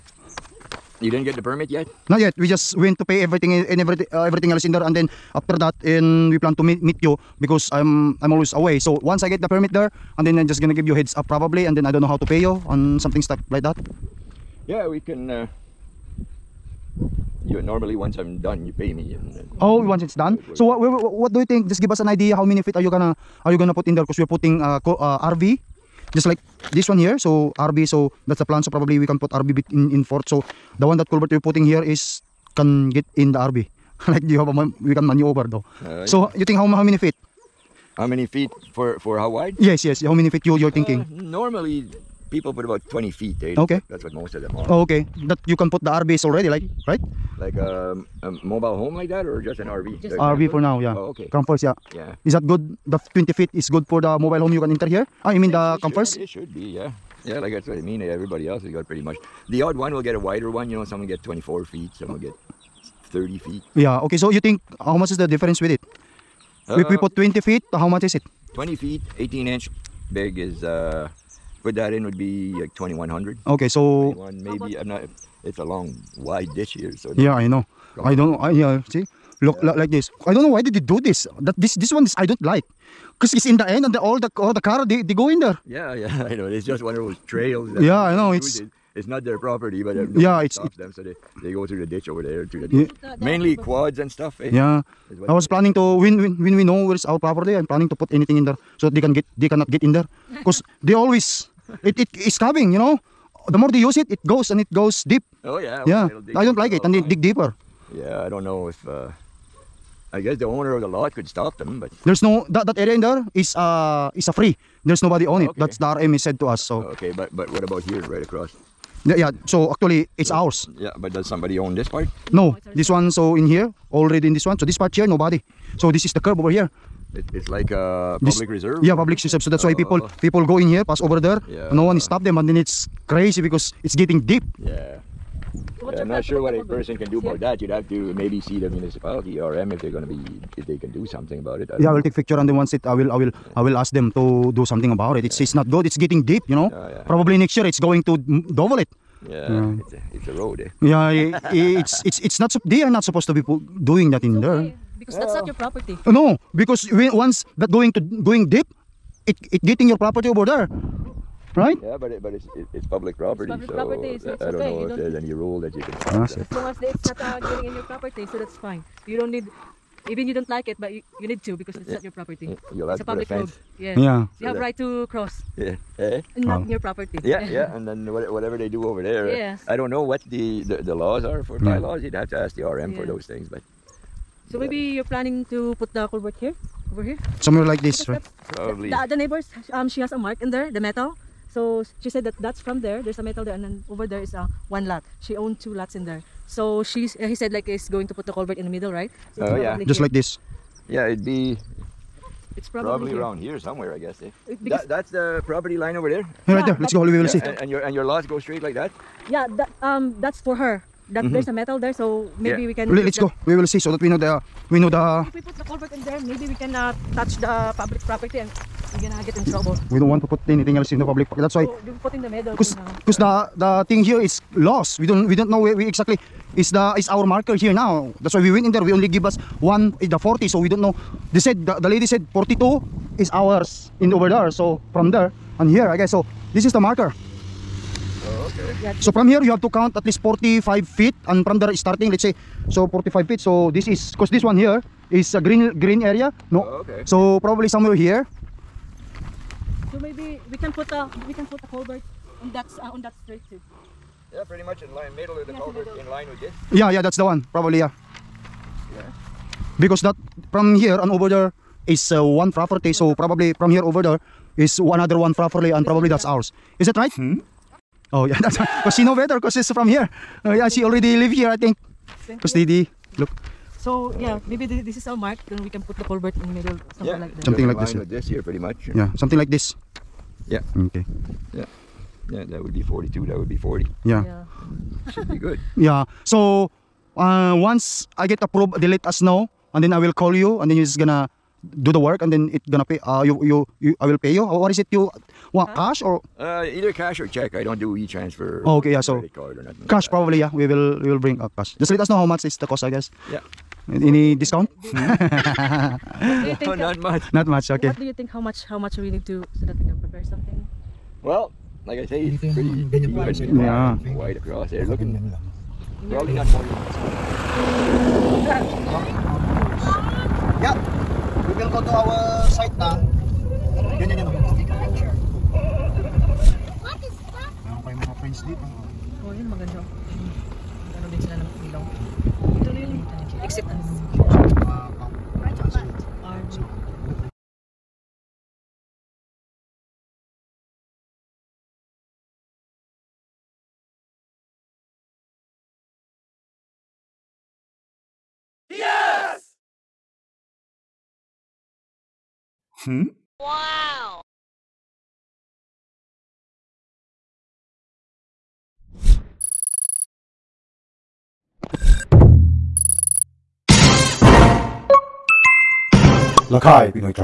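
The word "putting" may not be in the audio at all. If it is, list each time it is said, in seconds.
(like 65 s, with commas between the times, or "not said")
24 s, 31 s.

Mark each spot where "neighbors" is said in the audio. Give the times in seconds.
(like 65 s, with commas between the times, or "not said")
189 s.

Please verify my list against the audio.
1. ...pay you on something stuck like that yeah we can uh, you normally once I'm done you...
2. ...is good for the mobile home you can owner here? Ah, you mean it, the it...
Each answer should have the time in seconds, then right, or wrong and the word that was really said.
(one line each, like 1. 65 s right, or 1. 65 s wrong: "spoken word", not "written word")
1. 12 s right
2. 53 s wrong: "enter", not "owner".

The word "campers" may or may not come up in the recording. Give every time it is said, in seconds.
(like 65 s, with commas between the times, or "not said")
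51 s, 55 s.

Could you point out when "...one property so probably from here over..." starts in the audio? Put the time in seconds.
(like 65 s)
262 s.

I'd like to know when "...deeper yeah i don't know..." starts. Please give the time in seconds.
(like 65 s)
107 s.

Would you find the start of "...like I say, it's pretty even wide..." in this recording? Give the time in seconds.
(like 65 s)
311 s.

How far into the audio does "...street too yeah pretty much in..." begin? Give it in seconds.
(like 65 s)
253 s.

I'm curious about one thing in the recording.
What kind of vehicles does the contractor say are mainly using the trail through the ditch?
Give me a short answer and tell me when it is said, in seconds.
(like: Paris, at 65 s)
quads, at 93 s.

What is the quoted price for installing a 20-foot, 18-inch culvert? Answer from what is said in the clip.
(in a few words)
2100.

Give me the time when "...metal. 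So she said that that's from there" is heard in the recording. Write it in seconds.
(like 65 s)
190 s.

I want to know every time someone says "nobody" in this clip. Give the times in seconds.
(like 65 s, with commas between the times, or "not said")
115 s, 125 s.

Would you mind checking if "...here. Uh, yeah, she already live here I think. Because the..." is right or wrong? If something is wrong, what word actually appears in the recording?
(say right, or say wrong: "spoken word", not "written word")
right.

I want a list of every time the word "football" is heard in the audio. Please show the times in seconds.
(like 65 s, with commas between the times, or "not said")
not said.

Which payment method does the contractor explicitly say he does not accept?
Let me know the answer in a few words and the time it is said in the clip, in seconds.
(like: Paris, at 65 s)
e-transfer, at 297 s.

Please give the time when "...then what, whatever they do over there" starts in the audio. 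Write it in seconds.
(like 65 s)
177 s.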